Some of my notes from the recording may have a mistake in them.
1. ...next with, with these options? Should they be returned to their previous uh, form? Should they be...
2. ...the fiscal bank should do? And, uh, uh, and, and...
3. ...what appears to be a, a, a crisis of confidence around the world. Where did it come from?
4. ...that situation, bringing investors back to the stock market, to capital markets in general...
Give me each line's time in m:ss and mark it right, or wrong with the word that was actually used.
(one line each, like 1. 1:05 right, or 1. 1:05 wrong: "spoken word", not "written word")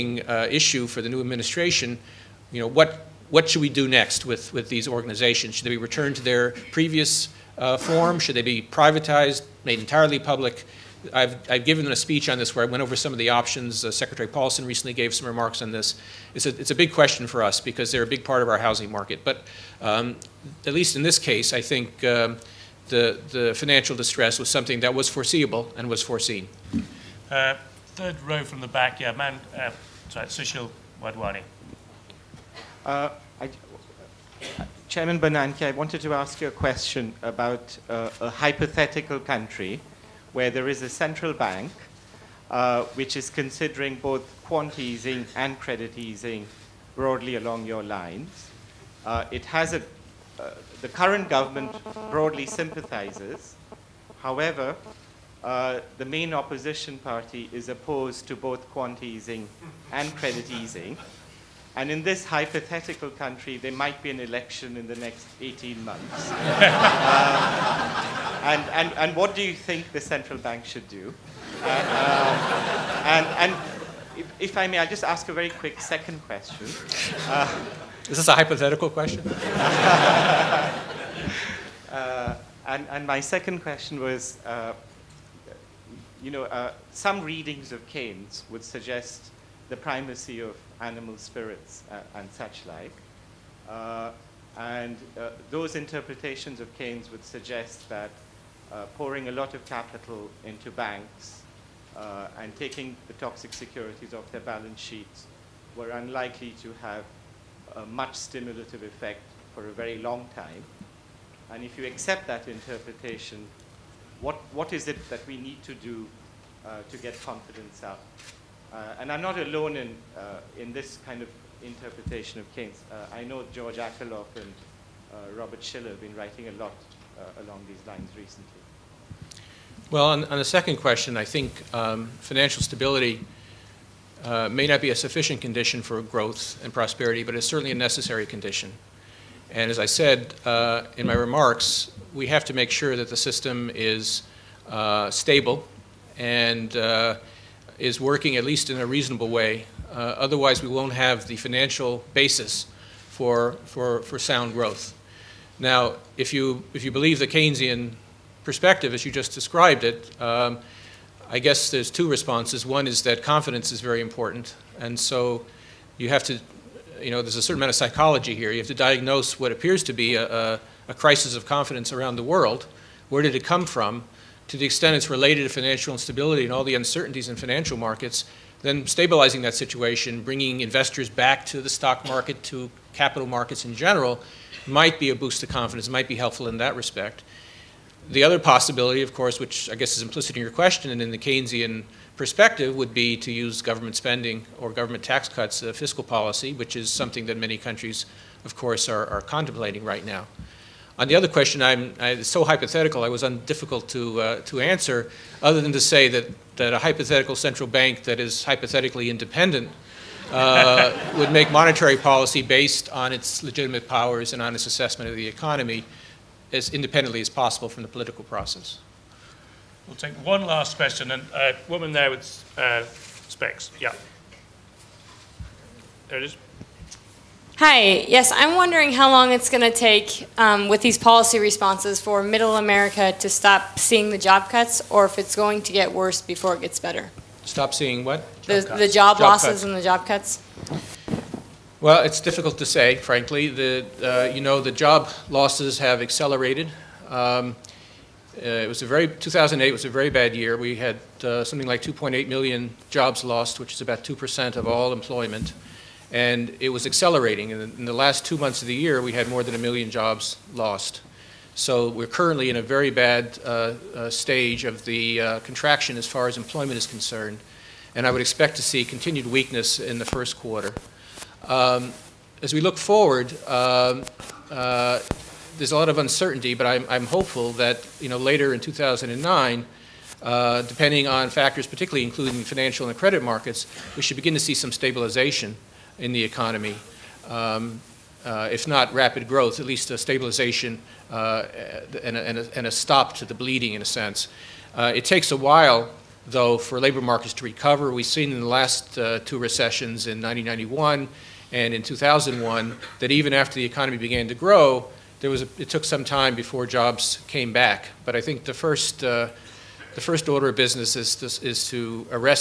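1. 0:03 wrong: "organizations", not "options"
2. 1:09 wrong: "central", not "fiscal"
3. 2:49 right
4. 2:59 right.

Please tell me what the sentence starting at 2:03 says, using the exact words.
I know George Akerlof and Robert Shiller have been writing a lot uh, along these lines recently?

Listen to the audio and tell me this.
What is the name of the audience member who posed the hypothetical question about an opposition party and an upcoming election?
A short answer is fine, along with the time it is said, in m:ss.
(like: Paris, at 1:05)
Sushil Wadhwani, at 0:30.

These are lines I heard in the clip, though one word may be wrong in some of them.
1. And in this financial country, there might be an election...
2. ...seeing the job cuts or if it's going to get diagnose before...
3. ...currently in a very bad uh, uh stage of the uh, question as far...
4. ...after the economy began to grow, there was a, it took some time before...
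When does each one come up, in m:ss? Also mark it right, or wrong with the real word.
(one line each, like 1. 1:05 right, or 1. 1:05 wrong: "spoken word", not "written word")
1. 1:01 wrong: "hypothetical", not "financial"
2. 3:53 wrong: "worse", not "diagnose"
3. 4:22 wrong: "contraction", not "question"
4. 5:03 right.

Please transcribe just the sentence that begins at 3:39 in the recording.
We'll take one last question, and a uh, woman there with uh, specs.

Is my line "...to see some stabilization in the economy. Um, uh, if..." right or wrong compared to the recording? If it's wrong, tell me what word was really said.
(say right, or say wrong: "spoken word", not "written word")
right.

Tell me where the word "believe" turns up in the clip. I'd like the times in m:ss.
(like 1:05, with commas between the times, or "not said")
2:36.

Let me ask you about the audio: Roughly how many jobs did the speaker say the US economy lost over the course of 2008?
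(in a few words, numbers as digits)
2.8 million.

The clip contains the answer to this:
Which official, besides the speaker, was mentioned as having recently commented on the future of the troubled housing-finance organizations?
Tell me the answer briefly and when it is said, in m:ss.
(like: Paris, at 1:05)
Secretary Paulson, at 0:13.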